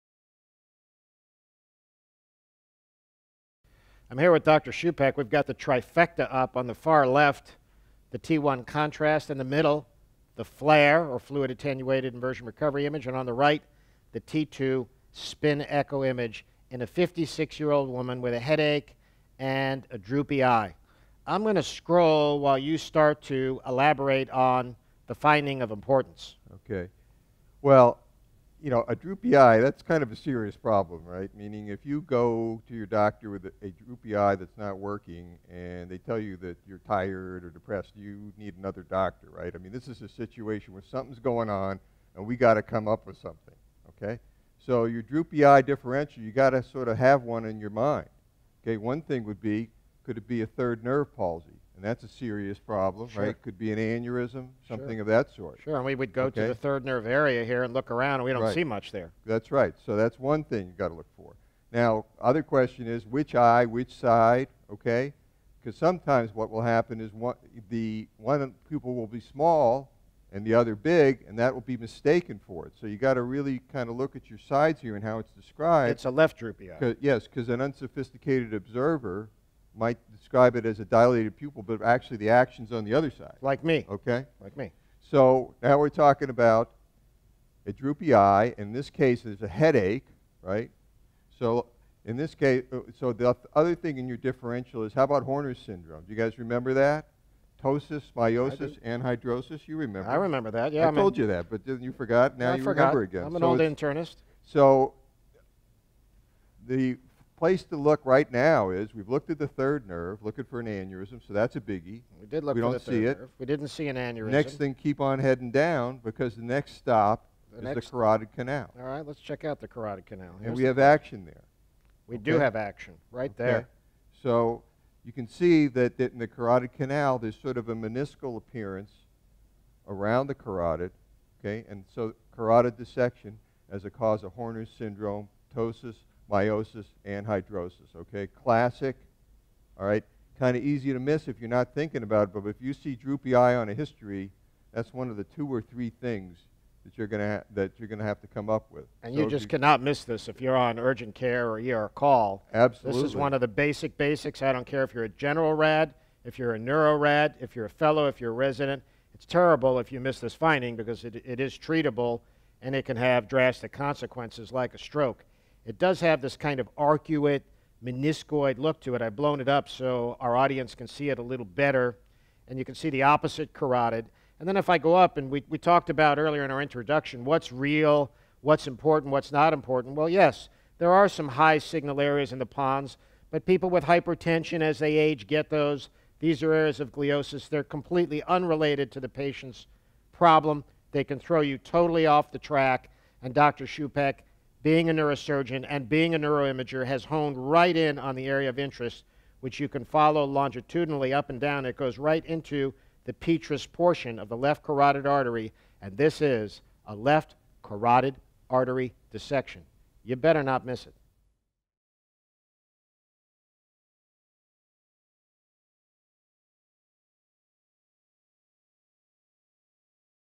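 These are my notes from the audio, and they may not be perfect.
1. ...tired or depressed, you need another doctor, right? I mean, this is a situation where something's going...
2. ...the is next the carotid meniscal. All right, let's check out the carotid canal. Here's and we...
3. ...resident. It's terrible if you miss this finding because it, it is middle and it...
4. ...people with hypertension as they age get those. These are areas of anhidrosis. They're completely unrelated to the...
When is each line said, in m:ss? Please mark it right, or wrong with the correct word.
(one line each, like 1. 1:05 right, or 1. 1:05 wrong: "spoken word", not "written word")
1. 0:36 right
2. 1:57 wrong: "canal", not "meniscal"
3. 2:38 wrong: "treatable", not "middle"
4. 3:03 wrong: "gliosis", not "anhidrosis".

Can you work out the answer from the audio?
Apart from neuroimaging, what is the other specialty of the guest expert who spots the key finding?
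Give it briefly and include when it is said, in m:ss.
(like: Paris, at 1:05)
Neurosurgeon, at 3:14.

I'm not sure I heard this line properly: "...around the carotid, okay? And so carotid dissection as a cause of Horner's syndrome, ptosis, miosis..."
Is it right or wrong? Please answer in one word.
right.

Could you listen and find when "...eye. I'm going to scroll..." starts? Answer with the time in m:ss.
0:20.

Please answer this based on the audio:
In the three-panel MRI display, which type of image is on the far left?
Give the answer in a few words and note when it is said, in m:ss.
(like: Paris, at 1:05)
T1 contrast, at 0:08.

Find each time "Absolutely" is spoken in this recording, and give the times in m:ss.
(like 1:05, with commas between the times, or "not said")
2:32.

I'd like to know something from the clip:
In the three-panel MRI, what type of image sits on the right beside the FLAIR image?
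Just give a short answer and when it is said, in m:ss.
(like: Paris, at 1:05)
T2 spin echo, at 0:14.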